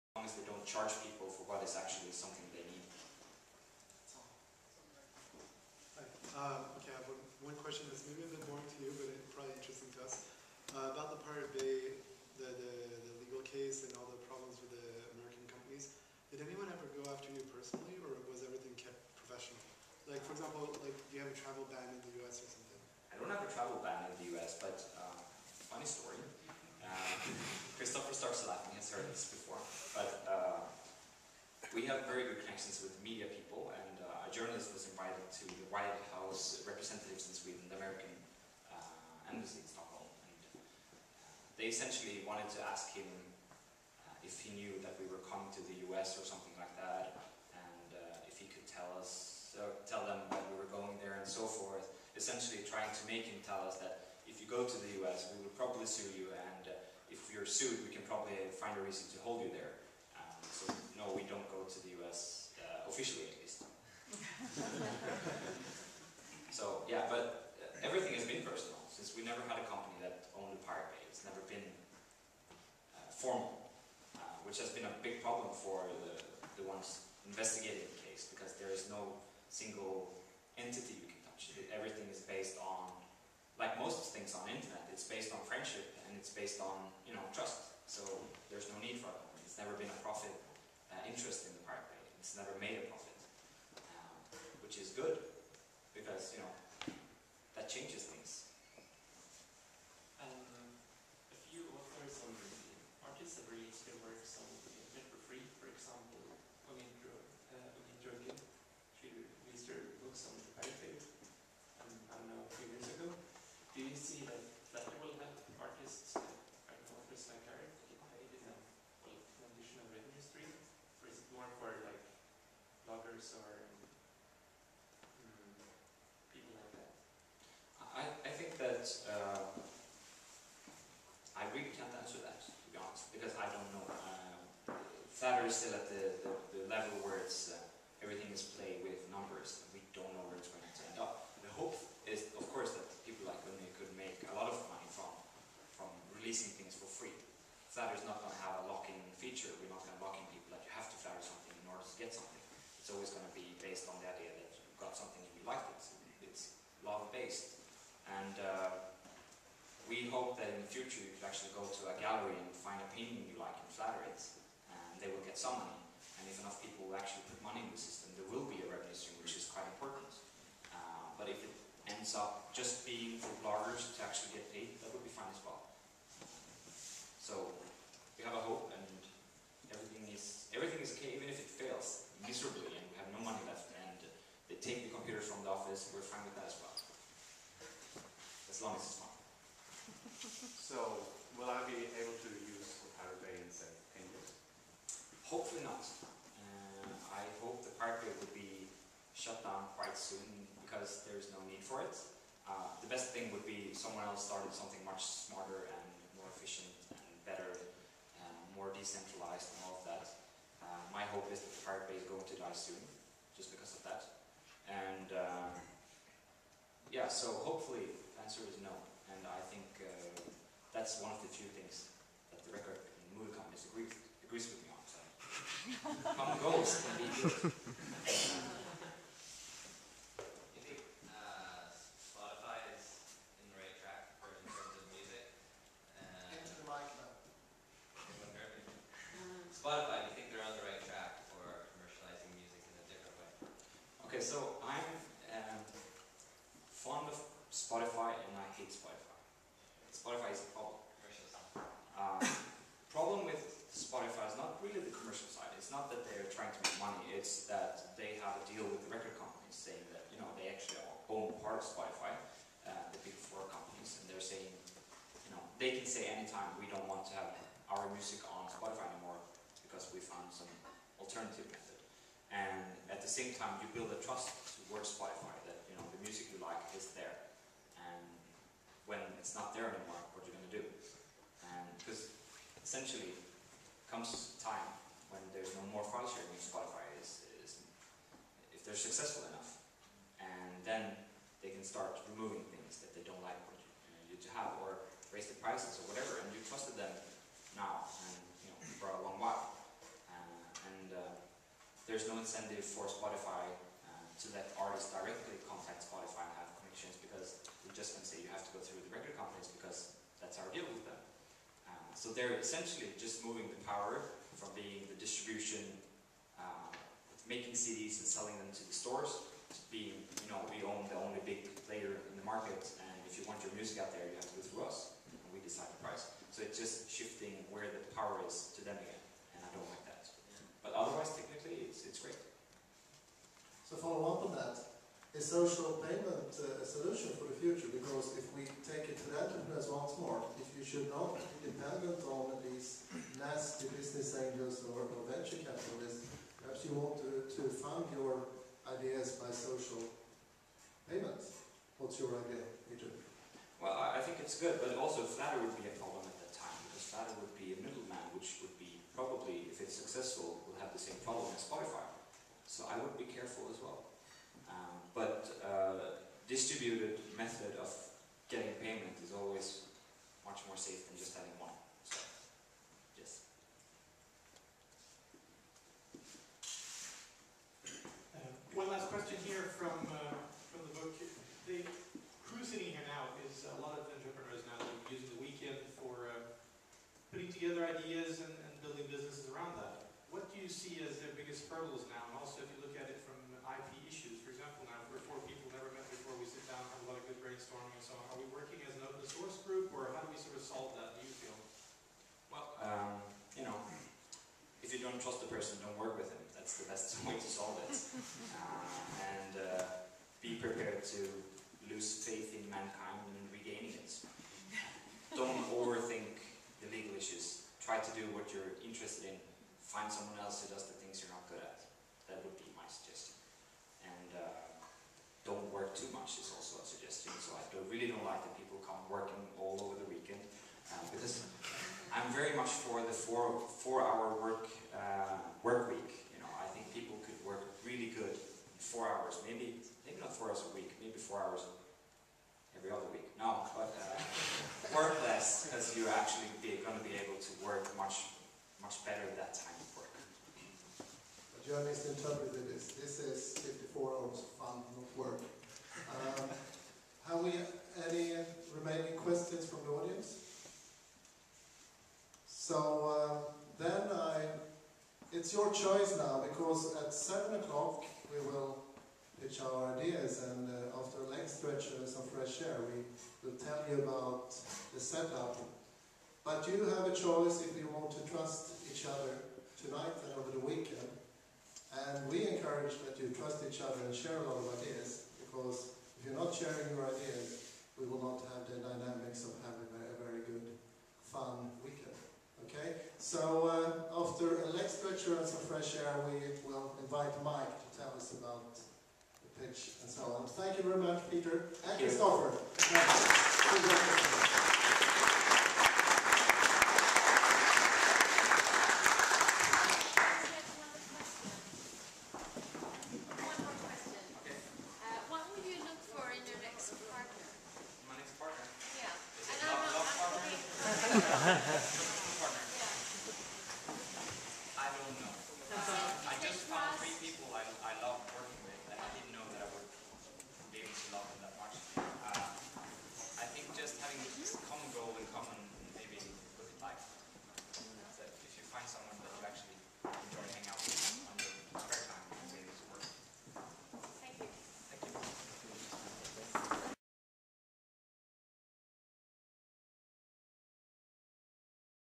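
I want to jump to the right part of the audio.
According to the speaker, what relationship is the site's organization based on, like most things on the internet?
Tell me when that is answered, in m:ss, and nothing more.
1:25.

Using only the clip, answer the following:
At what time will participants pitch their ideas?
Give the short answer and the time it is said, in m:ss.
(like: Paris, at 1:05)
7 o'clock, at 7:46.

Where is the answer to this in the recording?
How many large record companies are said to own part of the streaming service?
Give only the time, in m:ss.
4:22.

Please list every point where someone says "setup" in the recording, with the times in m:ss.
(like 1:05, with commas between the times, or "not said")
7:54.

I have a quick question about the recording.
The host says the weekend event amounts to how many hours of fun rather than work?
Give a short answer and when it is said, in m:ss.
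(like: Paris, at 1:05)
54, at 7:33.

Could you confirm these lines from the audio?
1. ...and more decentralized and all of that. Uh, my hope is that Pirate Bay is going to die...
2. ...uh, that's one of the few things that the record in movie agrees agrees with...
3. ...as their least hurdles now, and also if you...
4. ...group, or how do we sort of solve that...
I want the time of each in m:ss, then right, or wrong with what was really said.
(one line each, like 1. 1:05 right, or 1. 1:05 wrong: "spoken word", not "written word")
1. 3:28 right
2. 3:39 right
3. 6:30 wrong: "biggest", not "least"
4. 6:39 right.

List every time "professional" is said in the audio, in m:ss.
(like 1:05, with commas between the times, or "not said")
0:19.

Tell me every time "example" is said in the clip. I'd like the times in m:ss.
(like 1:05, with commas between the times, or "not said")
0:20, 6:34.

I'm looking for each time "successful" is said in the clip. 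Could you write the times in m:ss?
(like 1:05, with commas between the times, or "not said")
4:48, 5:59.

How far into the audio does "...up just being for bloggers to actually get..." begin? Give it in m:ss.
2:52.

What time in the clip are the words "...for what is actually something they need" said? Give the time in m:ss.
0:01.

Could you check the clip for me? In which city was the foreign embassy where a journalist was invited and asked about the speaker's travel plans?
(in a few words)
Stockholm.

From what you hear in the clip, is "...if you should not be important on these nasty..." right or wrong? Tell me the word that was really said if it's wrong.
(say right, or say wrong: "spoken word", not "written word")
wrong: "dependent", not "important".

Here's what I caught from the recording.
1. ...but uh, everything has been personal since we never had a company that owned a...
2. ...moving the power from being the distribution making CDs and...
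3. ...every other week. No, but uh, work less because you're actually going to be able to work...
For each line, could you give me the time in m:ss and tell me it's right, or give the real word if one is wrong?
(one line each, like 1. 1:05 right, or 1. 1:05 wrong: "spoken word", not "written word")
1. 1:07 right
2. 5:13 right
3. 7:22 right.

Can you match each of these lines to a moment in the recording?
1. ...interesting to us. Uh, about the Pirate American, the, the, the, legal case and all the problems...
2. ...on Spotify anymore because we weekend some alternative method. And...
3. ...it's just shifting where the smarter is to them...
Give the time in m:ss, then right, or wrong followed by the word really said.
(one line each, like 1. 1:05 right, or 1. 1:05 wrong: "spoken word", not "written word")
1. 0:09 wrong: "Bay", not "American"
2. 4:28 wrong: "found", not "weekend"
3. 5:26 wrong: "power", not "smarter".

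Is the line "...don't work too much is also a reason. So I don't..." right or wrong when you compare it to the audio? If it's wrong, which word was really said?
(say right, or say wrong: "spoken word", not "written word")
wrong: "suggestion", not "reason".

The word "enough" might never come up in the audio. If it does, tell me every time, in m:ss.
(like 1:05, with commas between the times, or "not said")
2:46, 4:49.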